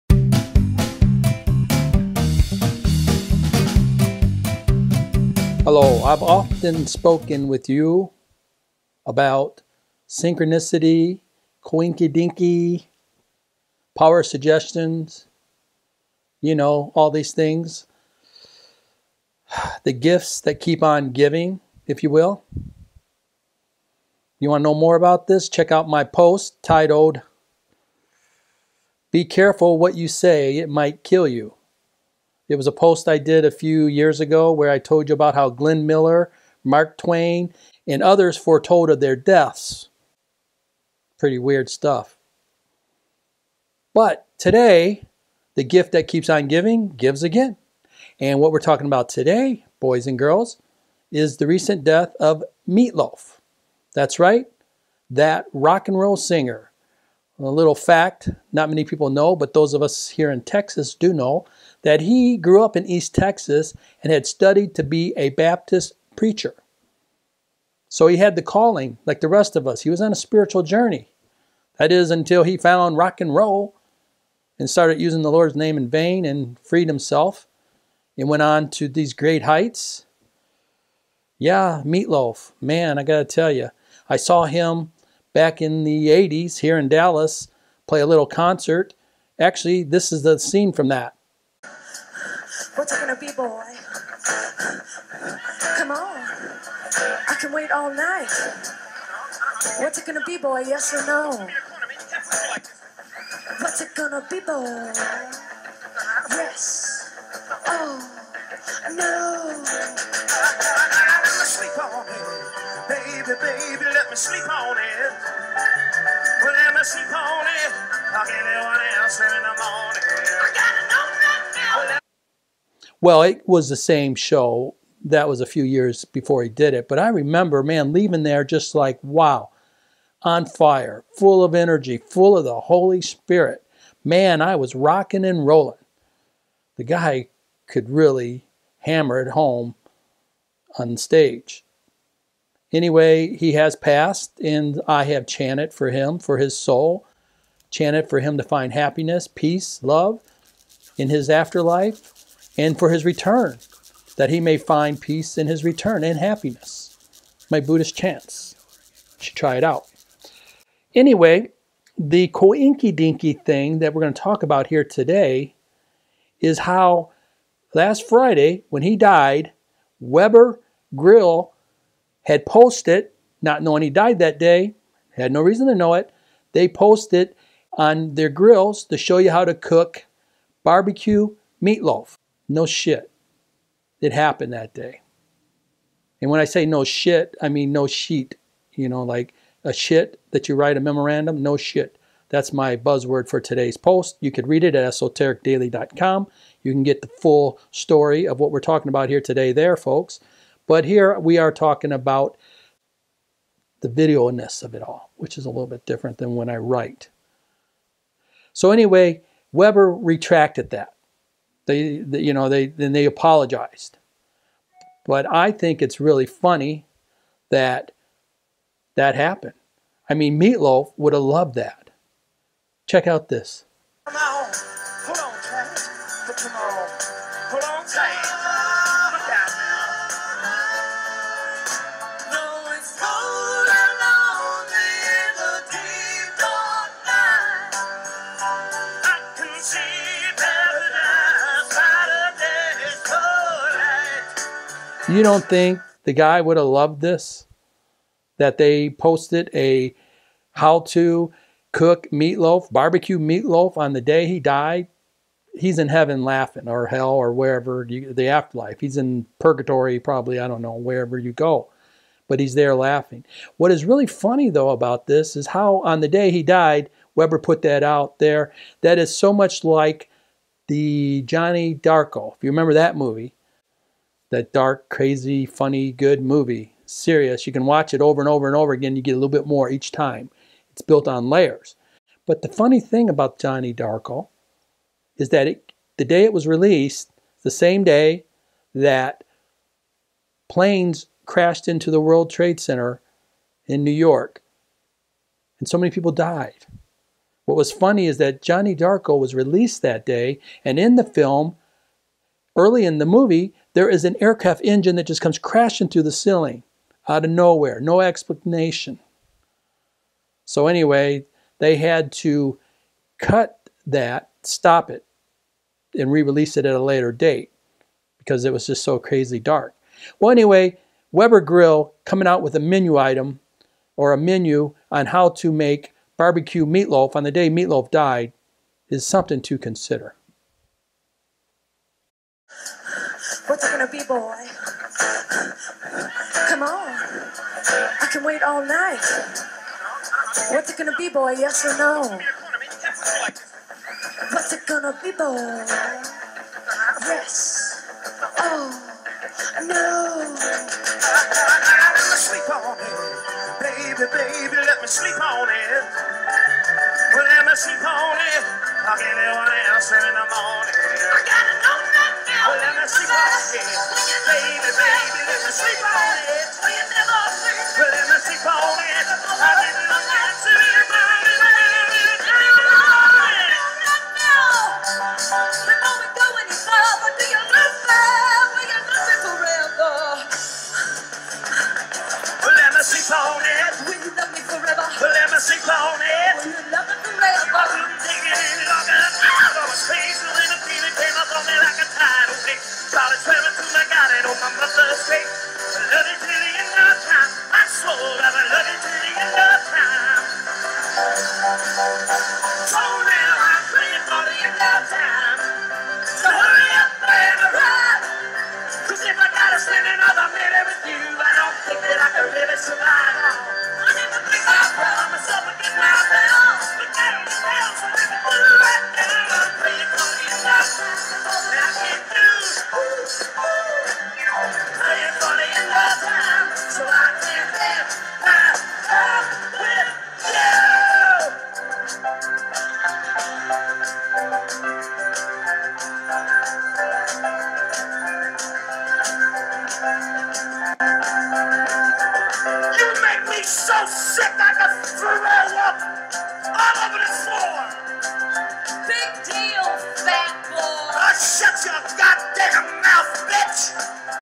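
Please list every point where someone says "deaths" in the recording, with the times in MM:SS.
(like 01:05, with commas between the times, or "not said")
00:39, 00:51.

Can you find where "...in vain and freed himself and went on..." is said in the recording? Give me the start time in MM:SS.
01:15.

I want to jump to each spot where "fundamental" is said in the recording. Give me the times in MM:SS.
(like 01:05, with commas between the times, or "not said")
not said.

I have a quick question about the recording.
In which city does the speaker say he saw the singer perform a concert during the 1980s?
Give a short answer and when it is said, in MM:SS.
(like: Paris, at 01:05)
Dallas, at 01:26.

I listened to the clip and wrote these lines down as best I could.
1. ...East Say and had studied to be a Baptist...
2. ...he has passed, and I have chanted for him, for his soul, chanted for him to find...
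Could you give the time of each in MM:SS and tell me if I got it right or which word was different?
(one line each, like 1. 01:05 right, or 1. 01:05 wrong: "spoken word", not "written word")
1. 01:02 wrong: "Texas", not "Say"
2. 02:23 right.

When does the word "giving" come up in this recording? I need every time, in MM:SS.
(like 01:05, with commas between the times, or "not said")
00:21, 00:46.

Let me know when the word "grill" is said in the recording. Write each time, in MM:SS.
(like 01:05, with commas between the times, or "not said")
02:50, 02:58, 05:21.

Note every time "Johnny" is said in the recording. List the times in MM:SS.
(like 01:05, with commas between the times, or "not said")
04:31, 04:43, 04:58.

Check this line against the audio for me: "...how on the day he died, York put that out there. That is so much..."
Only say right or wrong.
wrong.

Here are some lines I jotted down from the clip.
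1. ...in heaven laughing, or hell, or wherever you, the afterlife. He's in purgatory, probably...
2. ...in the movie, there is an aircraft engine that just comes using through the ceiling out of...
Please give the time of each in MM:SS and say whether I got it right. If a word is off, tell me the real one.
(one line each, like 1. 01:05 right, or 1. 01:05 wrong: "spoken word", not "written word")
1. 04:15 right
2. 05:02 wrong: "crashing", not "using".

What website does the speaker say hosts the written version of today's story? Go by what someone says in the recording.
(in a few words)
esotericdaily.com.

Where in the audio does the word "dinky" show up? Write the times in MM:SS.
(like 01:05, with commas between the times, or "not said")
00:12, 02:42.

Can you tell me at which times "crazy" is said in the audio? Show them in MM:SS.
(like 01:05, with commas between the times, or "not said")
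04:34, 05:18.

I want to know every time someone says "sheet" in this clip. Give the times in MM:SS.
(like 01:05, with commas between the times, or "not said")
03:07.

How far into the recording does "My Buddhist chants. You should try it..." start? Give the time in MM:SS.
02:37.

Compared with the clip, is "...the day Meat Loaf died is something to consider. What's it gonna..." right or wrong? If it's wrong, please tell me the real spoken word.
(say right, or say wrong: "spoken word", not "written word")
right.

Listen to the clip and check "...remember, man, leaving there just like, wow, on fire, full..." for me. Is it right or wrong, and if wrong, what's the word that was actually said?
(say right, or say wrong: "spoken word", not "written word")
right.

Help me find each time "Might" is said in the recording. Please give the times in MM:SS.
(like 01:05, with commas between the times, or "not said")
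00:30.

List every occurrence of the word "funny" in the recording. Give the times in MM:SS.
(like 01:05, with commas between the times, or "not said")
03:36, 04:24, 04:35, 04:42, 04:57.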